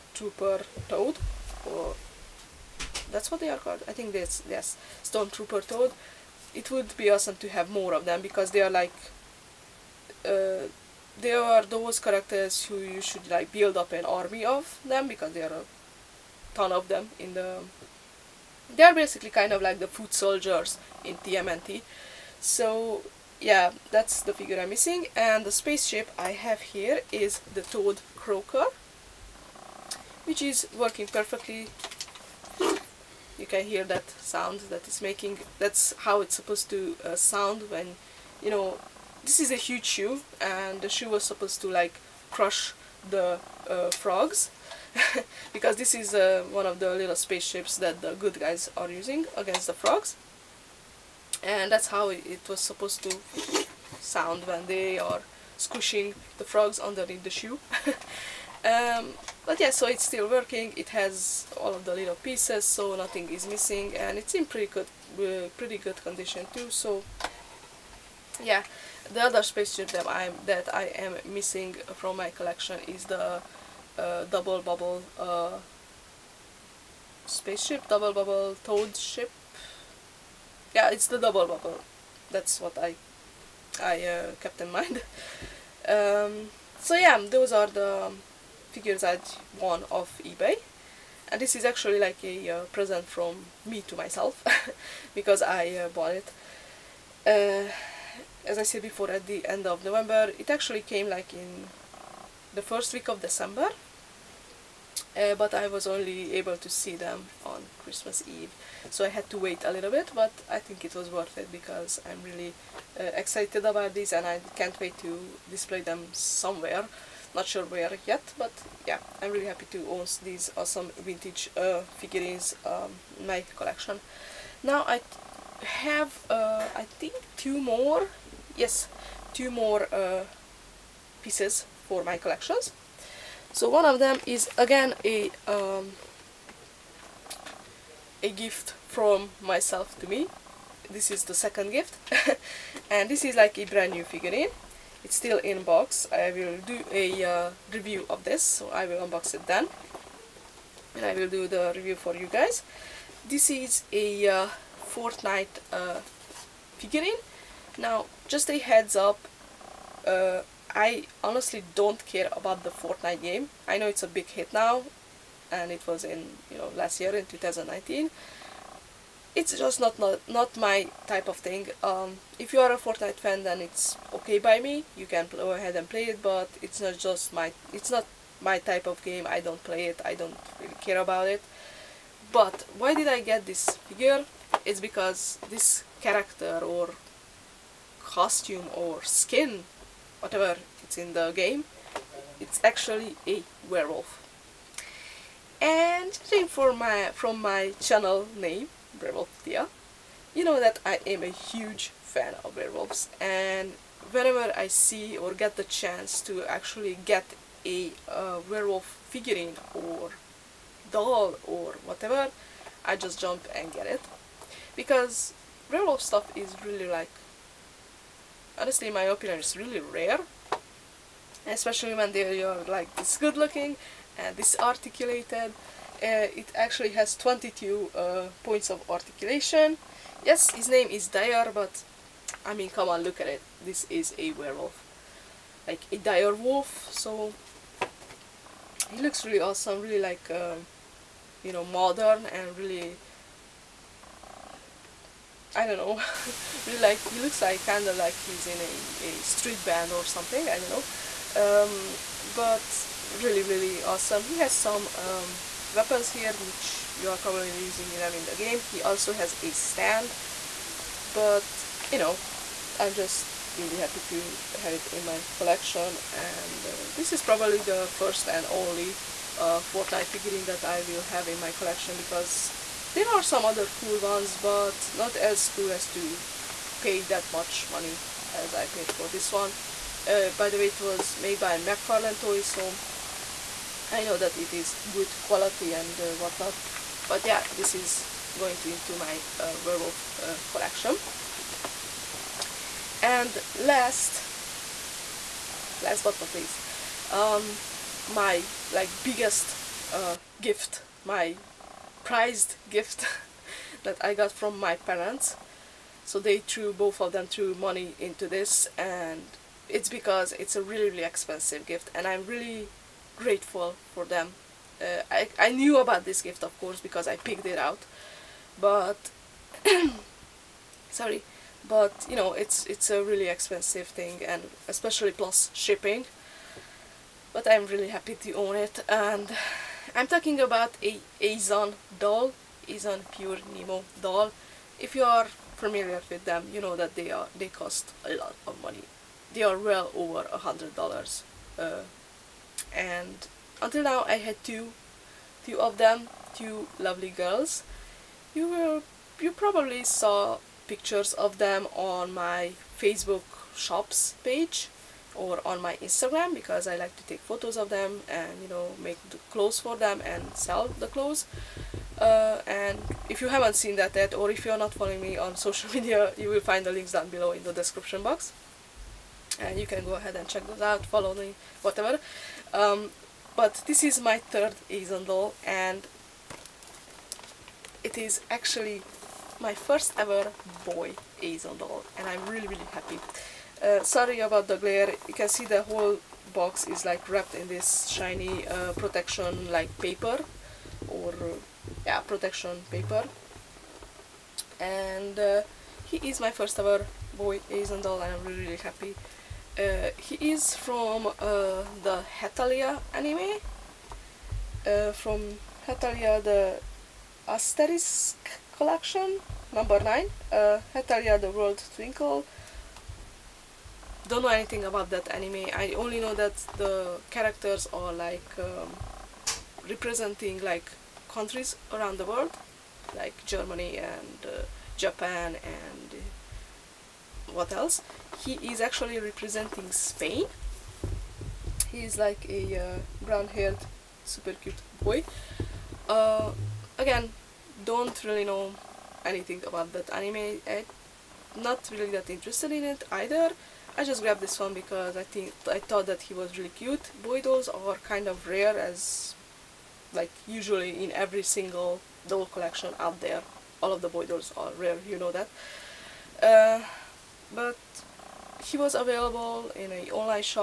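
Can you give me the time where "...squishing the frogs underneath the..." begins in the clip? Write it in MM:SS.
00:55.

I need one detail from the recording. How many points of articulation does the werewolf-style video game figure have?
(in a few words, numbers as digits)
22.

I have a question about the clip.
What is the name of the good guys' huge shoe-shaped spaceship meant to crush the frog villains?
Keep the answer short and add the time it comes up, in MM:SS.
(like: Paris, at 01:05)
Toad Croaker, at 00:27.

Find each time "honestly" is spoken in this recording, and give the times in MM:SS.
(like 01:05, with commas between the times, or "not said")
02:41, 03:38.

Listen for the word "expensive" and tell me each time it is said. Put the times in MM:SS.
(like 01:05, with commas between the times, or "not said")
05:11, 05:23.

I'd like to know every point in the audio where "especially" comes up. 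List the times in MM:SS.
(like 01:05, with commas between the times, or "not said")
03:41, 05:24.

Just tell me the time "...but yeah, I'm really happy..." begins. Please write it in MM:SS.
01:58.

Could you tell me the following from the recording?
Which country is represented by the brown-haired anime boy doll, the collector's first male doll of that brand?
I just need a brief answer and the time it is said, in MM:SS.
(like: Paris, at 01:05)
Spain, at 07:09.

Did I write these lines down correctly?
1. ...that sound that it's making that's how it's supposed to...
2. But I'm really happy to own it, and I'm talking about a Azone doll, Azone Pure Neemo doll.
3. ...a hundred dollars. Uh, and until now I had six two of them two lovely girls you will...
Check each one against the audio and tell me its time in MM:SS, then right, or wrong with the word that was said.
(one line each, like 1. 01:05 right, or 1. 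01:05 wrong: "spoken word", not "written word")
1. 00:33 right
2. 05:27 right
3. 05:40 wrong: "two", not "six".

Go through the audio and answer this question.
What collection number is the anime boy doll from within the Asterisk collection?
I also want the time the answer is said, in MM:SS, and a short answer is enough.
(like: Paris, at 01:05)
9, at 06:49.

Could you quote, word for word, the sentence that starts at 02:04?
Now I have, uh, I think, two more, yes, two more uh, pieces for my collections.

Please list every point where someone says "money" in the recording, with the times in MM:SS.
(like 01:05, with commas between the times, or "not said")
04:37, 05:07, 05:38.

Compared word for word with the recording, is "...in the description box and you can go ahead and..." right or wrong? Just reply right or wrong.
right.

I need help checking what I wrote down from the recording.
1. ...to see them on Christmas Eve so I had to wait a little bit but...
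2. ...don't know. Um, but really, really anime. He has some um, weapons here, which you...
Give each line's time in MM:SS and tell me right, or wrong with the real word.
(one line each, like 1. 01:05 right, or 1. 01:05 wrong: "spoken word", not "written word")
1. 01:46 right
2. 04:10 wrong: "awesome", not "anime".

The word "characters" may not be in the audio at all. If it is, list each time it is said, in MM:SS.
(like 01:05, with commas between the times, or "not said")
00:11, 03:06, 06:57.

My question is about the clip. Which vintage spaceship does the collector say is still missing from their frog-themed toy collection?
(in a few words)
Double bubble toad ship.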